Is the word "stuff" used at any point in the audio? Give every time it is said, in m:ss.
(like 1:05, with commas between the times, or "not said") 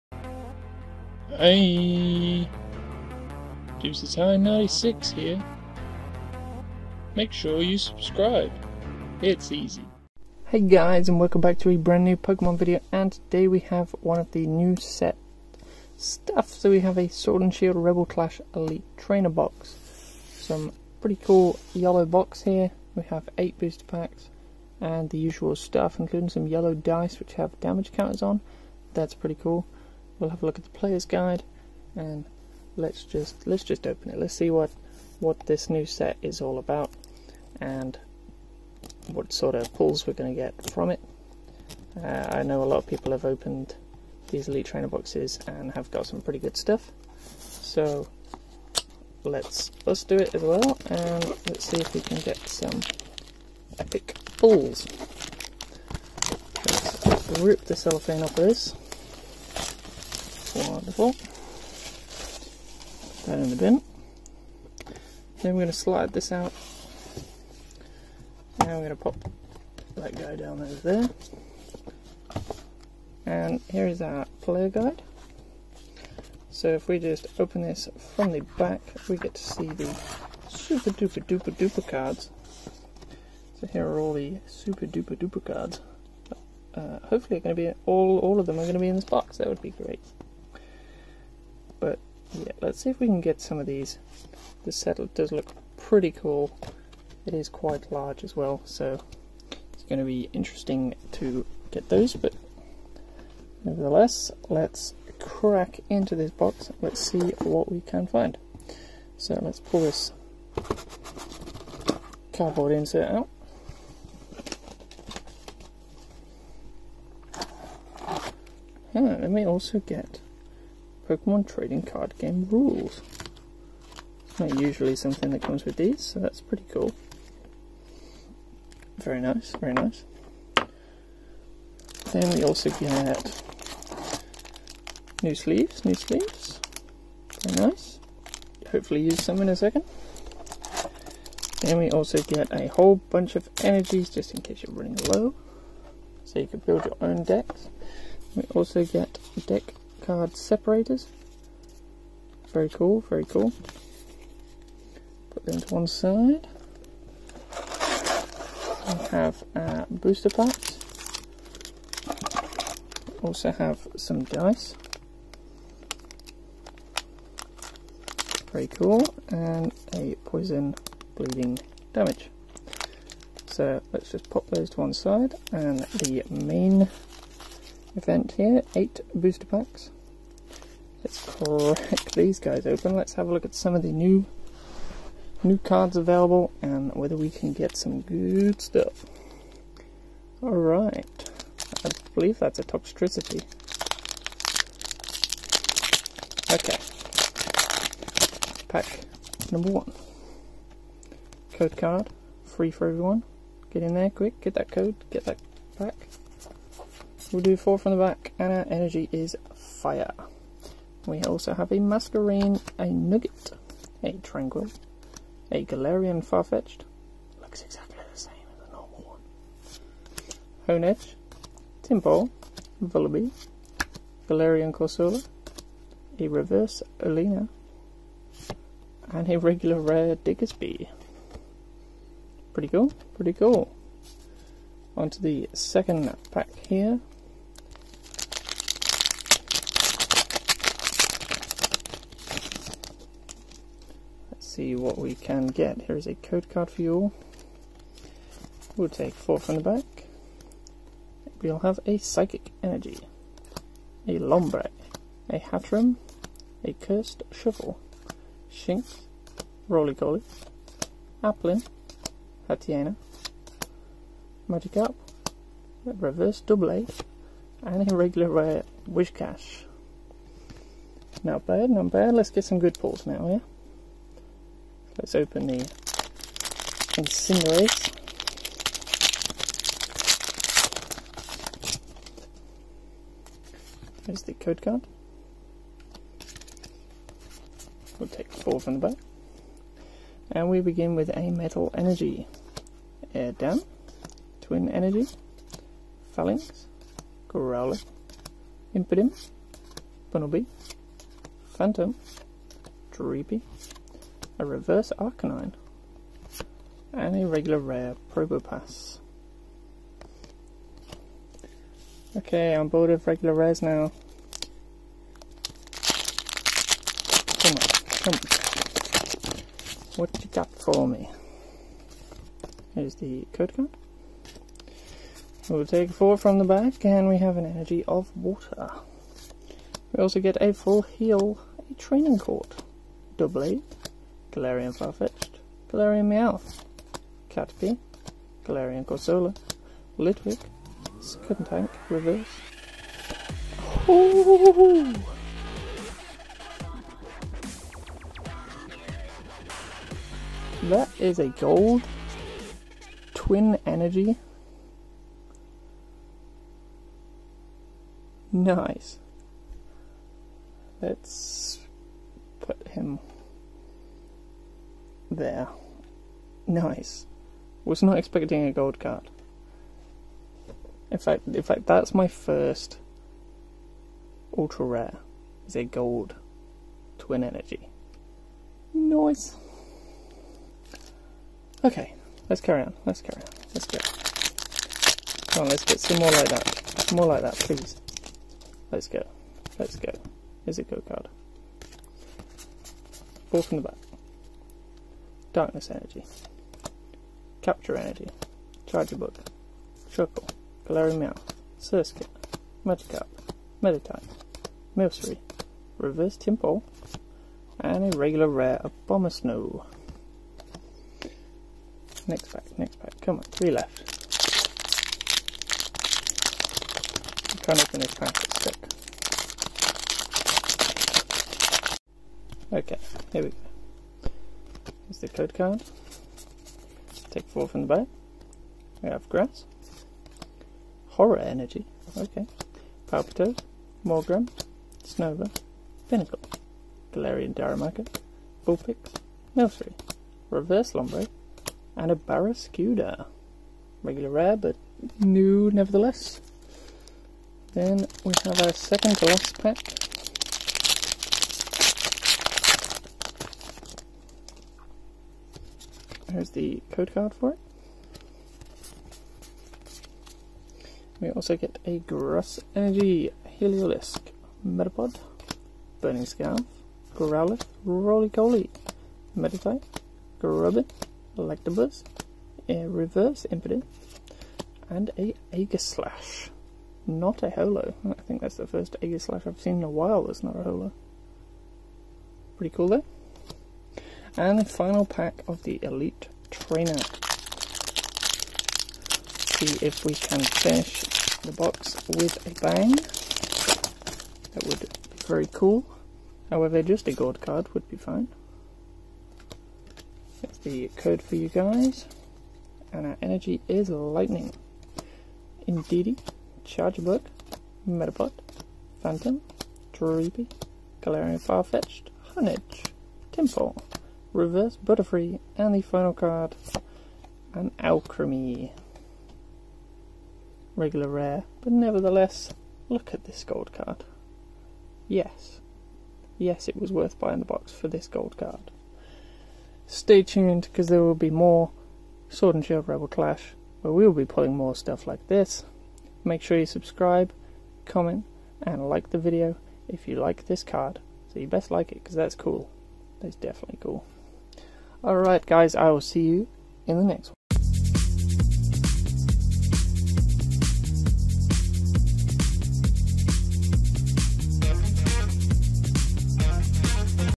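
0:15, 0:25, 0:46, 3:08, 8:54.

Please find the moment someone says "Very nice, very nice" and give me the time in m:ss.
2:08.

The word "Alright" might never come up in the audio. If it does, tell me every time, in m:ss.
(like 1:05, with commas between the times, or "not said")
3:10, 9:04.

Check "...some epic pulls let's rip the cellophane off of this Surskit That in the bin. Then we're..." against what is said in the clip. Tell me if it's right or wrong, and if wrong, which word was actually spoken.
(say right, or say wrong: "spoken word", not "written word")
wrong: "Put", not "Surskit".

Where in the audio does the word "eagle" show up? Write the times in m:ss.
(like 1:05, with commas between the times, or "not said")
not said.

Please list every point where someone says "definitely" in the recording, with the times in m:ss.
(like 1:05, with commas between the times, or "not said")
9:03.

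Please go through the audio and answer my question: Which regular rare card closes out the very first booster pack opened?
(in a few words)
Diggersby.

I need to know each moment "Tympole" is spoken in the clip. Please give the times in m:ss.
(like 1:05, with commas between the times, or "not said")
3:41, 6:46, 8:33.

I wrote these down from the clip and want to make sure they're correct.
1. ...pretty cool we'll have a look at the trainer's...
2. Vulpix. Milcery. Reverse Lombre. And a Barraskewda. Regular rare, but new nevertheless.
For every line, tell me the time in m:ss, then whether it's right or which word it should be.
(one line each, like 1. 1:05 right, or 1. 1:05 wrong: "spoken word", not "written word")
1. 0:29 wrong: "player", not "trainer"
2. 7:18 right.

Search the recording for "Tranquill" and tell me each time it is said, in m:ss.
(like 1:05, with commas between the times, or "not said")
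3:34.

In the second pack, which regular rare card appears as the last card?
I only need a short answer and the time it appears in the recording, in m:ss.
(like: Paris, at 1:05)
Whiscash, at 4:28.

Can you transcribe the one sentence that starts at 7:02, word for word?
Okay, here we go the code card.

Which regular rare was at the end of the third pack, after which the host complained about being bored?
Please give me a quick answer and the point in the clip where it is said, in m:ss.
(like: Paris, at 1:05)
Probopass, at 5:08.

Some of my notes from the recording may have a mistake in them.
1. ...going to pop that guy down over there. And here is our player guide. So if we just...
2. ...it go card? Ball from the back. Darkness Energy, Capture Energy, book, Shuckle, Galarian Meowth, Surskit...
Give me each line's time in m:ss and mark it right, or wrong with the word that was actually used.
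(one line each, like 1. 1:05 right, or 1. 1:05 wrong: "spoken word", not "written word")
1. 1:08 right
2. 6:30 right.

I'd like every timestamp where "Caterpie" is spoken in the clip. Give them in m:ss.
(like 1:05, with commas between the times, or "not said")
5:37.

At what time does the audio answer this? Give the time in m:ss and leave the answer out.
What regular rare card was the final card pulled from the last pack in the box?
8:37.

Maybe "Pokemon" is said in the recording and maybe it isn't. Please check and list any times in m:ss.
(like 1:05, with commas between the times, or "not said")
0:12, 2:01.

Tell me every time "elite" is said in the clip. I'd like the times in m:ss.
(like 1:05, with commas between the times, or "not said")
0:18, 0:44, 8:05.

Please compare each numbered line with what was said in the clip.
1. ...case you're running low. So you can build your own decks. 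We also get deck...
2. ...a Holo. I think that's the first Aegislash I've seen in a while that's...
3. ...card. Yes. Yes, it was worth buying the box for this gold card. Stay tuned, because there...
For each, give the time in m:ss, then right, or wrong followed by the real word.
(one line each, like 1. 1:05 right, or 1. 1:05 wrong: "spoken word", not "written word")
1. 2:24 right
2. 7:57 right
3. 8:43 right.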